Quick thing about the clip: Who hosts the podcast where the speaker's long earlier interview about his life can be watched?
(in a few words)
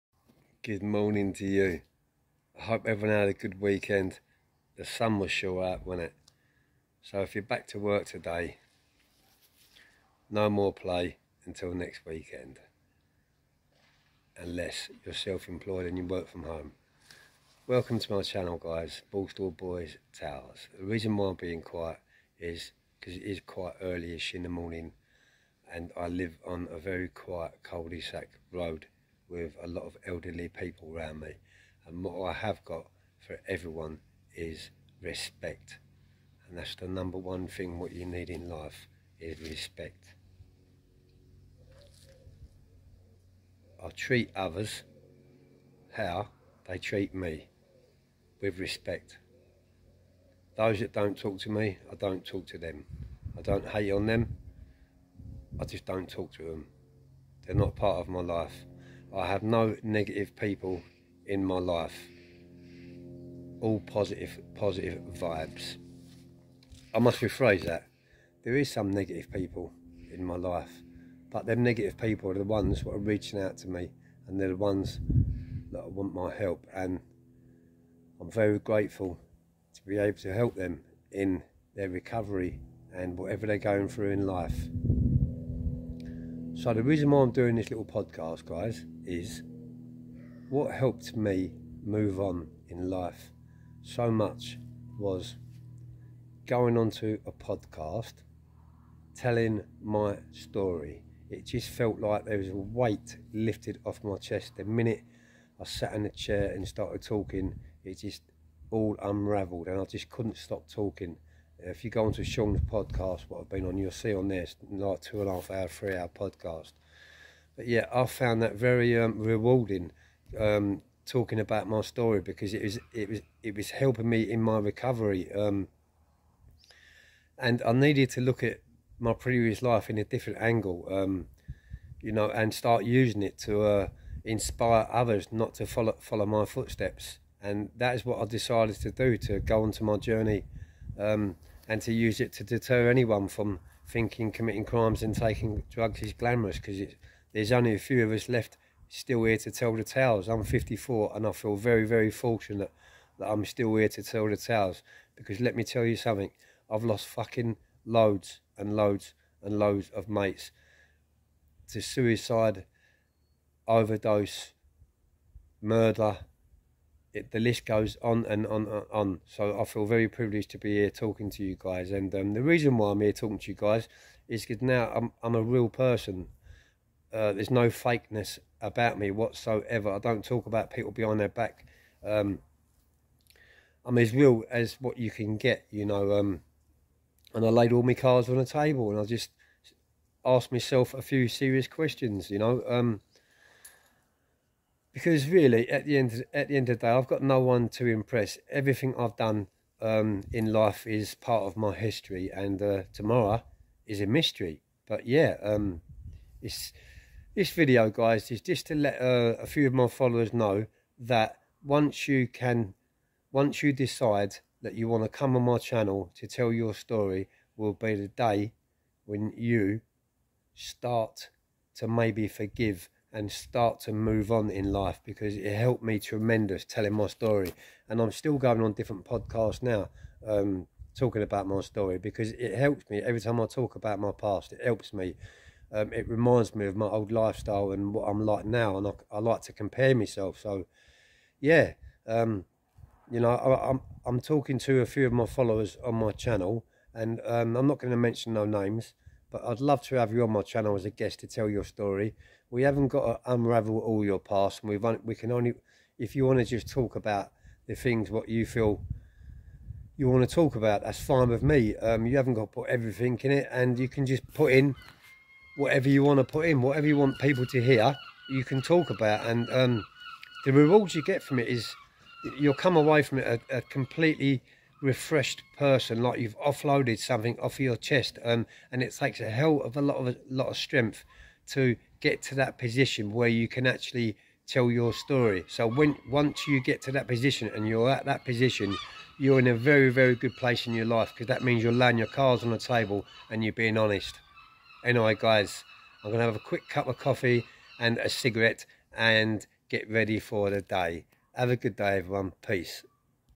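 Sean.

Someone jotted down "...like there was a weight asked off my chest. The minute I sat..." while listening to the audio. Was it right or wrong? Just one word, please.
wrong.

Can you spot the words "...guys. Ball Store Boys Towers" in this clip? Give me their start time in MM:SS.
00:18.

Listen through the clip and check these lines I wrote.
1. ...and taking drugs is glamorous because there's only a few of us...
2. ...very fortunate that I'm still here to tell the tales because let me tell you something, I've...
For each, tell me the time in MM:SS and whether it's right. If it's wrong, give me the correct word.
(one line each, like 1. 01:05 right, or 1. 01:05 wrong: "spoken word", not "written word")
1. 02:25 right
2. 02:31 right.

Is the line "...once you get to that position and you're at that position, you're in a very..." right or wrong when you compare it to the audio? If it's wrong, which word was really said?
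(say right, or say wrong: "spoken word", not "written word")
right.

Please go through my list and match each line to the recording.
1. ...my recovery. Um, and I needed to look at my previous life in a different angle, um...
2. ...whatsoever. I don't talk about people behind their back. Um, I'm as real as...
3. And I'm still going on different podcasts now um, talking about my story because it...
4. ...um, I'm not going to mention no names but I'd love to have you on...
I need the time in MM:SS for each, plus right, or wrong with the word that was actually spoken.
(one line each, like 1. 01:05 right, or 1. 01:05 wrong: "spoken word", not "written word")
1. 02:04 right
2. 02:59 right
3. 03:47 right
4. 04:07 right.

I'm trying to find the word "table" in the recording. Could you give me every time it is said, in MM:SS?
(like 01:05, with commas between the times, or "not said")
03:08, 04:52.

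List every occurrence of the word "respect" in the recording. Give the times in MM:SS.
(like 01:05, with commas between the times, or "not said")
00:35, 00:39, 00:48.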